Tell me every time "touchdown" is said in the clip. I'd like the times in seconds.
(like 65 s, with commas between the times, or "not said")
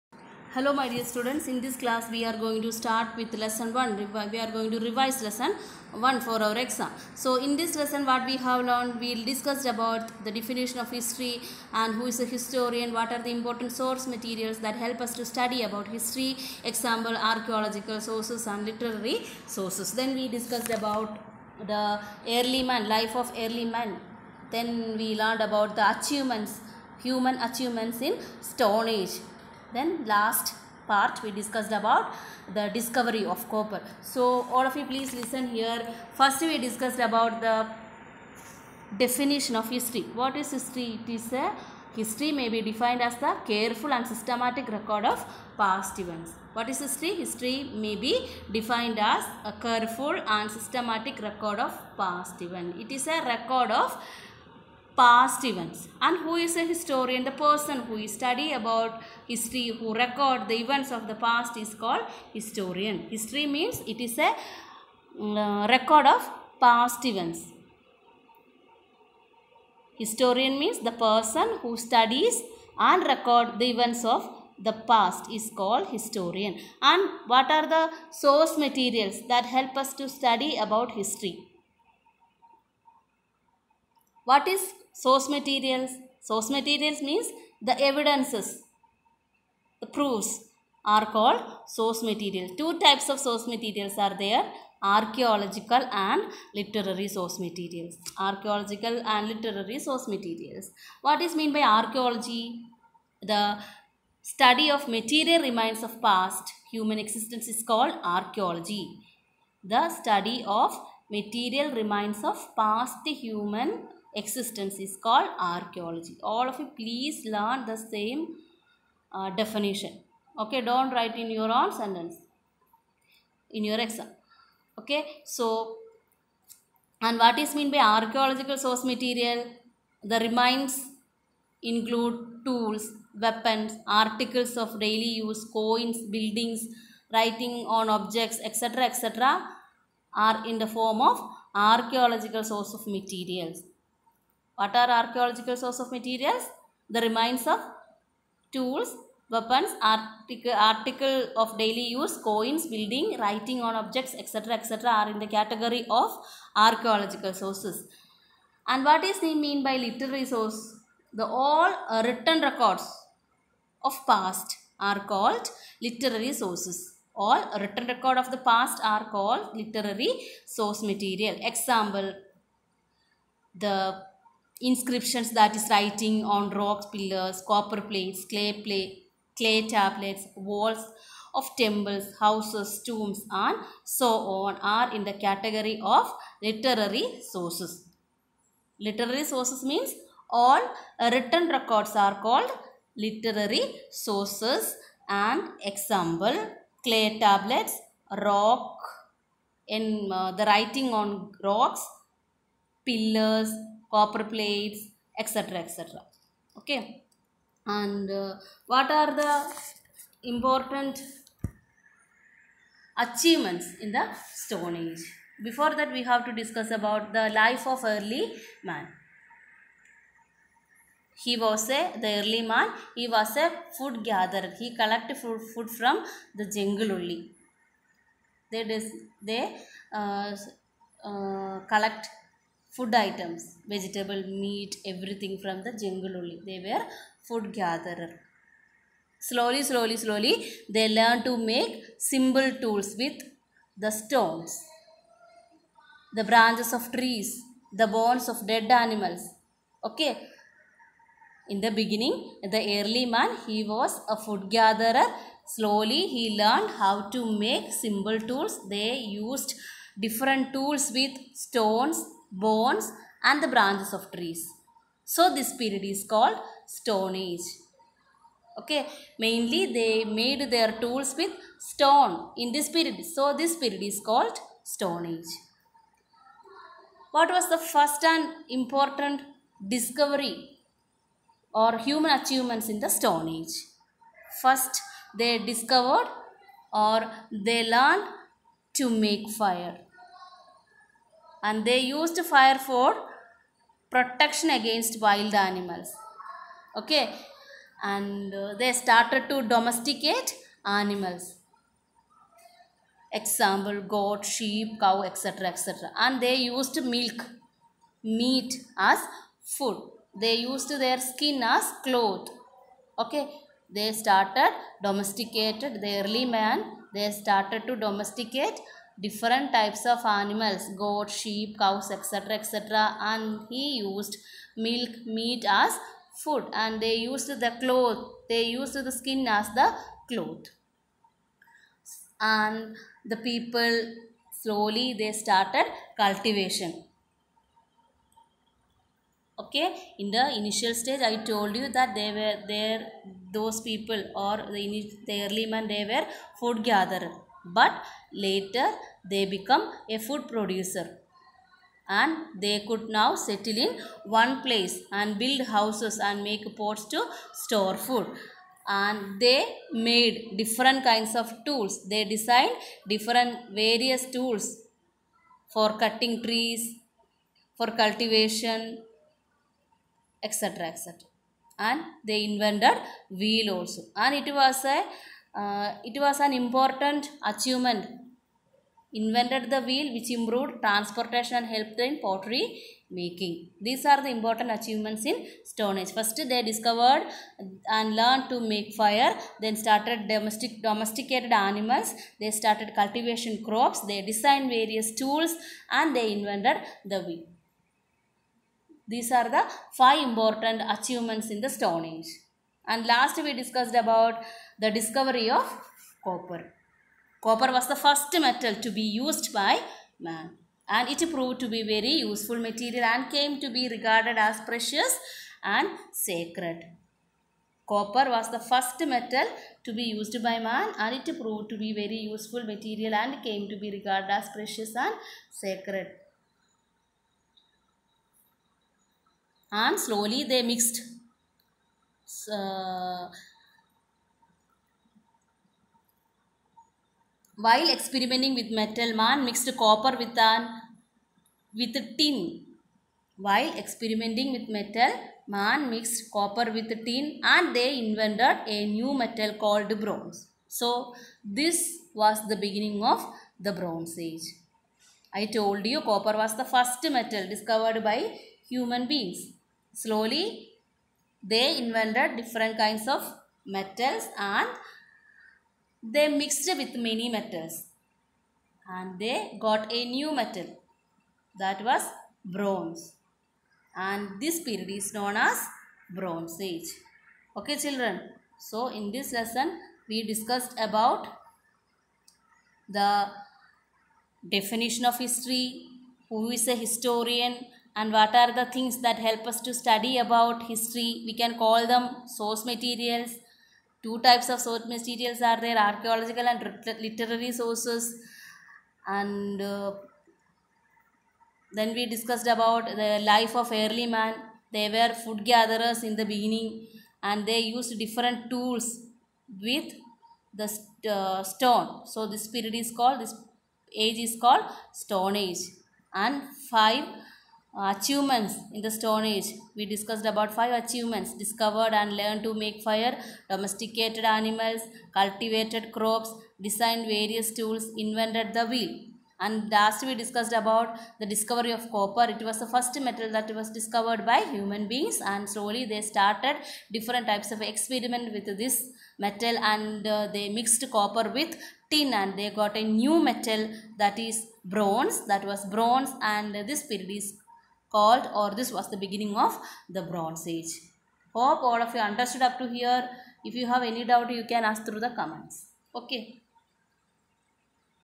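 not said.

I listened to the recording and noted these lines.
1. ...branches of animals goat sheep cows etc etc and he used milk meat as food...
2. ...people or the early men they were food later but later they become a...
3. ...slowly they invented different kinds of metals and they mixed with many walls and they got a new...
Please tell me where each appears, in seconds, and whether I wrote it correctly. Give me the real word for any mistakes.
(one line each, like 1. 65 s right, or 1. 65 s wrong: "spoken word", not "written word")
1. 319 s wrong: "types", not "branches"
2. 343 s wrong: "gatherer", not "later"
3. 459 s wrong: "metals", not "walls".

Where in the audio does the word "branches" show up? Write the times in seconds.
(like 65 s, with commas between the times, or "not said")
246 s, 263 s.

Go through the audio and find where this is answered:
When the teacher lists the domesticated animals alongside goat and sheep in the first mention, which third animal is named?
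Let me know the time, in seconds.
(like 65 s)
303 s.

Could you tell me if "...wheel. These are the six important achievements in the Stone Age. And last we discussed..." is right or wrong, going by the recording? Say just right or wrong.
wrong.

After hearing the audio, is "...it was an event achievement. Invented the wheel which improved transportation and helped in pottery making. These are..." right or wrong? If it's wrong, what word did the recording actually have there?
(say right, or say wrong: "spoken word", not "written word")
wrong: "important", not "event".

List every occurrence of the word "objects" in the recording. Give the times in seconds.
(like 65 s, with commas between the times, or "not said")
137 s, 153 s.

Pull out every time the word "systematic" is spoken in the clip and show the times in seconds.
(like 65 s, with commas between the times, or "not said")
44 s, 50 s.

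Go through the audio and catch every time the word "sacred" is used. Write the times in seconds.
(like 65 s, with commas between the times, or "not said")
415 s, 425 s.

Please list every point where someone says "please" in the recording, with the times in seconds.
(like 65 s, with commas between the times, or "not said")
34 s, 116 s.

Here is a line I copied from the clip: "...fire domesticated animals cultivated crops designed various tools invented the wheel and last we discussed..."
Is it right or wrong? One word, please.
right.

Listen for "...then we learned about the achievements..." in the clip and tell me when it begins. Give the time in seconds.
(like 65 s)
24 s.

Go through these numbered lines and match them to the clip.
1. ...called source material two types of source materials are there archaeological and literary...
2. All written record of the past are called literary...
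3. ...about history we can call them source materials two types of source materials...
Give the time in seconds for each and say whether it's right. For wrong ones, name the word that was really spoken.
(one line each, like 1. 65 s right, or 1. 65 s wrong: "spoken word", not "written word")
1. 91 s right
2. 167 s right
3. 489 s right.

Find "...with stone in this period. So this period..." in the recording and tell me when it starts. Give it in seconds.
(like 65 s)
271 s.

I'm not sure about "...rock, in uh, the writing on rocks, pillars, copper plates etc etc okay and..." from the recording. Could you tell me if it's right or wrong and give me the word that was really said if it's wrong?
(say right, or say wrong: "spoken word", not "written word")
right.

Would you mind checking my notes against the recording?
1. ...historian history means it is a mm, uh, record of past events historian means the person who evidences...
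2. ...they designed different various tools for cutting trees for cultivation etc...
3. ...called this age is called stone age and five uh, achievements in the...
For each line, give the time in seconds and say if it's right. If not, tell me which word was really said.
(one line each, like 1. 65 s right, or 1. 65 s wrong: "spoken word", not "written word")
1. 62 s wrong: "studies", not "evidences"
2. 361 s right
3. 512 s right.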